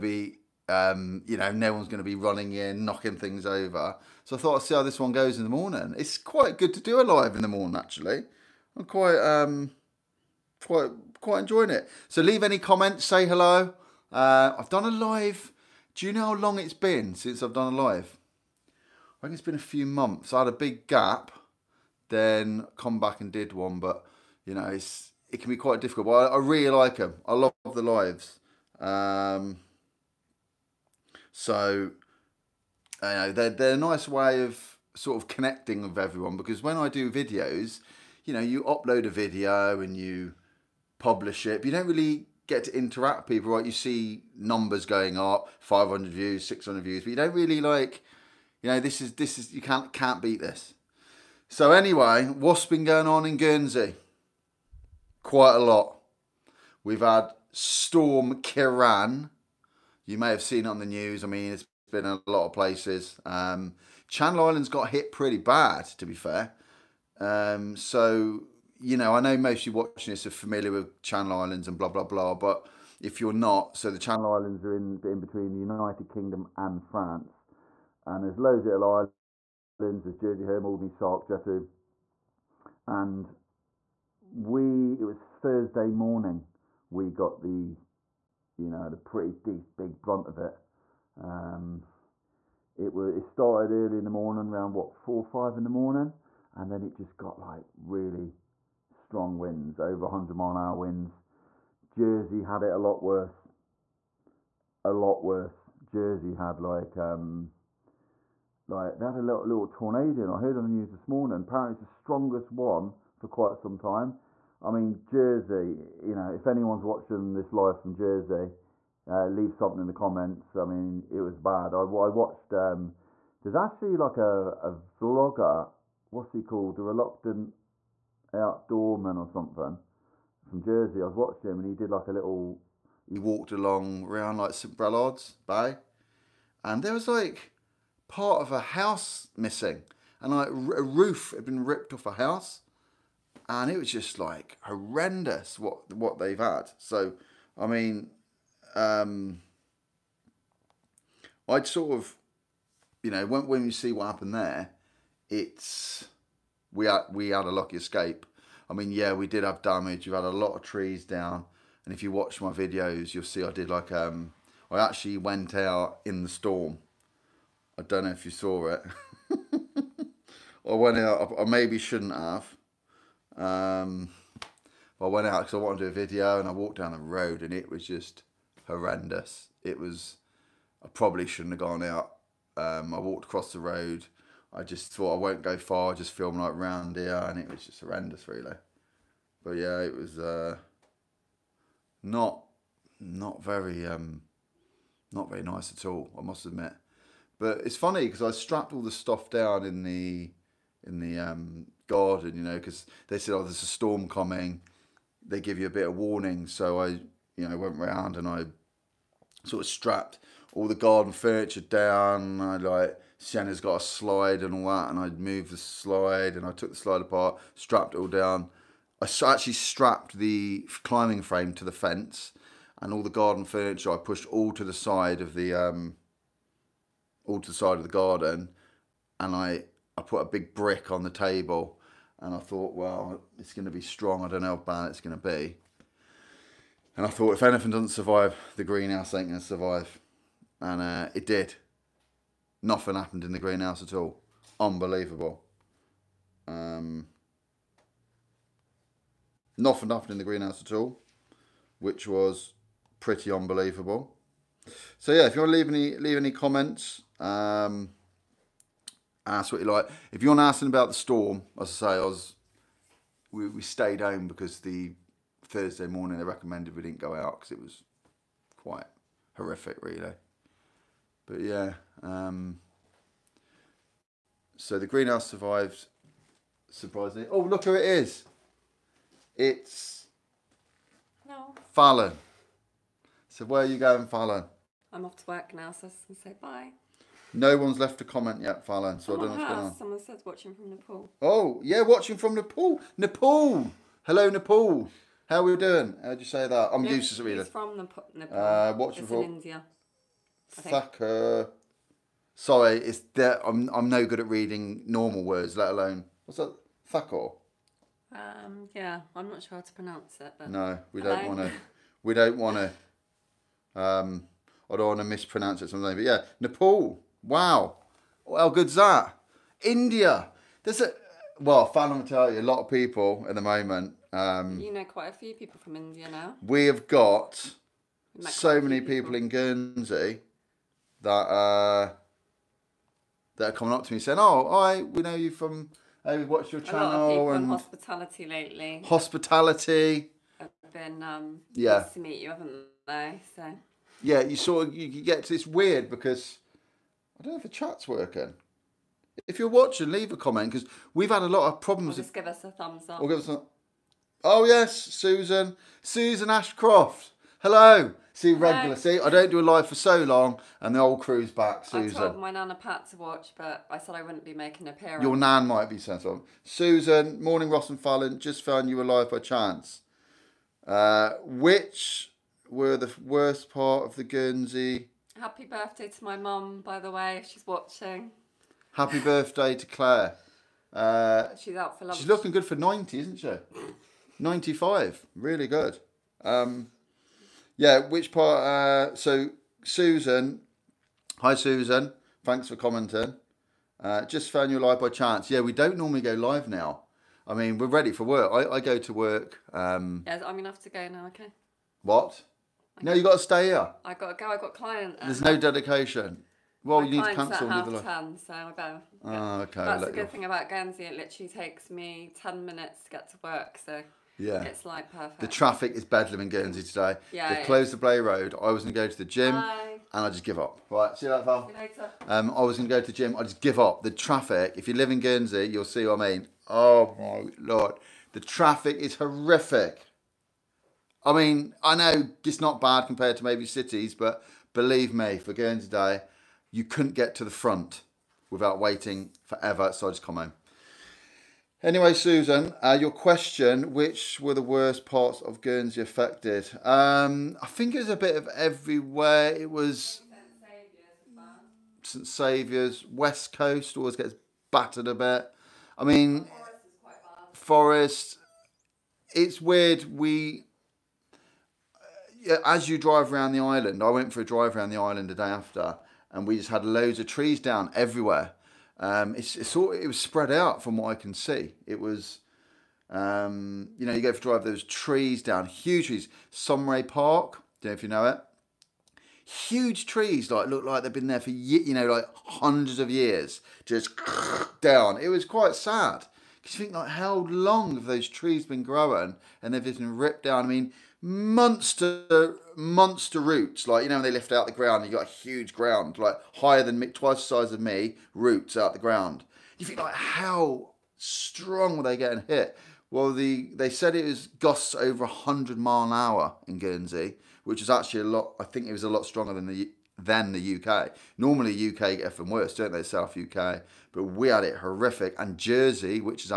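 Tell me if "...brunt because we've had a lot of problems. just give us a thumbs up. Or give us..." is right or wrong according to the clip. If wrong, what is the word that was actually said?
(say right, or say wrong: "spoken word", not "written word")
wrong: "comment", not "brunt".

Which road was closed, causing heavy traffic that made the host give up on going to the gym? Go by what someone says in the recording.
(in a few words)
Blay Road.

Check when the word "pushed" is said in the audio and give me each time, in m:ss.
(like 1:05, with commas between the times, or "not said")
3:43.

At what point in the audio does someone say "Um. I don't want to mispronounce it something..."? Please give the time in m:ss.
5:13.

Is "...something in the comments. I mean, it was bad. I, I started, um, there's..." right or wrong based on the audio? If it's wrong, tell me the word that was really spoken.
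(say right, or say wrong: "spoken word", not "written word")
wrong: "watched", not "started".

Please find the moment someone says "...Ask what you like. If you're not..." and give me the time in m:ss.
4:19.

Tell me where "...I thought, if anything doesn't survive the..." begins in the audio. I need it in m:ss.
3:57.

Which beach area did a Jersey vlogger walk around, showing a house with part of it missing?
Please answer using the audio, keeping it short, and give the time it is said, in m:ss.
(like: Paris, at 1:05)
St. Brelade's Bay, at 2:14.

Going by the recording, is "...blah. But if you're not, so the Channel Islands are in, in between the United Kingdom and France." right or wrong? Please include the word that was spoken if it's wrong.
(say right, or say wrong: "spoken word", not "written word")
right.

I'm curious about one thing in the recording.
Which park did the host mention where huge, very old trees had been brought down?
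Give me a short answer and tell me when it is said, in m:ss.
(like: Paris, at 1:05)
Saumarez Park, at 7:56.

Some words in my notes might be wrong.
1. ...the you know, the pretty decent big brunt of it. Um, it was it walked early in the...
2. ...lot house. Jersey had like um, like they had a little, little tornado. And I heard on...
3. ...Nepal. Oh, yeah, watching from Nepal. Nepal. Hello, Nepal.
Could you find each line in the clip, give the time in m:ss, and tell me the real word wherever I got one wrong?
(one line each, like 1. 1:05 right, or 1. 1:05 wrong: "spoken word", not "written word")
1. 1:27 wrong: "started", not "walked"
2. 1:44 wrong: "worse", not "house"
3. 4:50 right.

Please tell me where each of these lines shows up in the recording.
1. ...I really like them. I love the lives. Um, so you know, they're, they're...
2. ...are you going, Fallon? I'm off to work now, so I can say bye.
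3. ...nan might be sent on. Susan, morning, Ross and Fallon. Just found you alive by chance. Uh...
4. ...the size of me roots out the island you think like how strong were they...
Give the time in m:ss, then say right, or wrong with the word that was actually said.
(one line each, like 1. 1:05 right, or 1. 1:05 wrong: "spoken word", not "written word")
1. 0:26 right
2. 4:43 right
3. 6:05 right
4. 8:17 wrong: "ground", not "island".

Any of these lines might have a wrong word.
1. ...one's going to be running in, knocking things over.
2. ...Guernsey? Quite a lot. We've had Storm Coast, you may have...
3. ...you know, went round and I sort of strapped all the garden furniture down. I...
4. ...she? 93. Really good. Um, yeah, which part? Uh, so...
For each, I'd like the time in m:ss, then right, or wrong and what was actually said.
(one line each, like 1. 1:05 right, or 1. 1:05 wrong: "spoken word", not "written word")
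1. 0:01 right
2. 0:53 wrong: "Ciarán", not "Coast"
3. 3:27 right
4. 6:23 wrong: "95", not "93".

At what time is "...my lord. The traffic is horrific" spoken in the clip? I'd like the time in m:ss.
7:06.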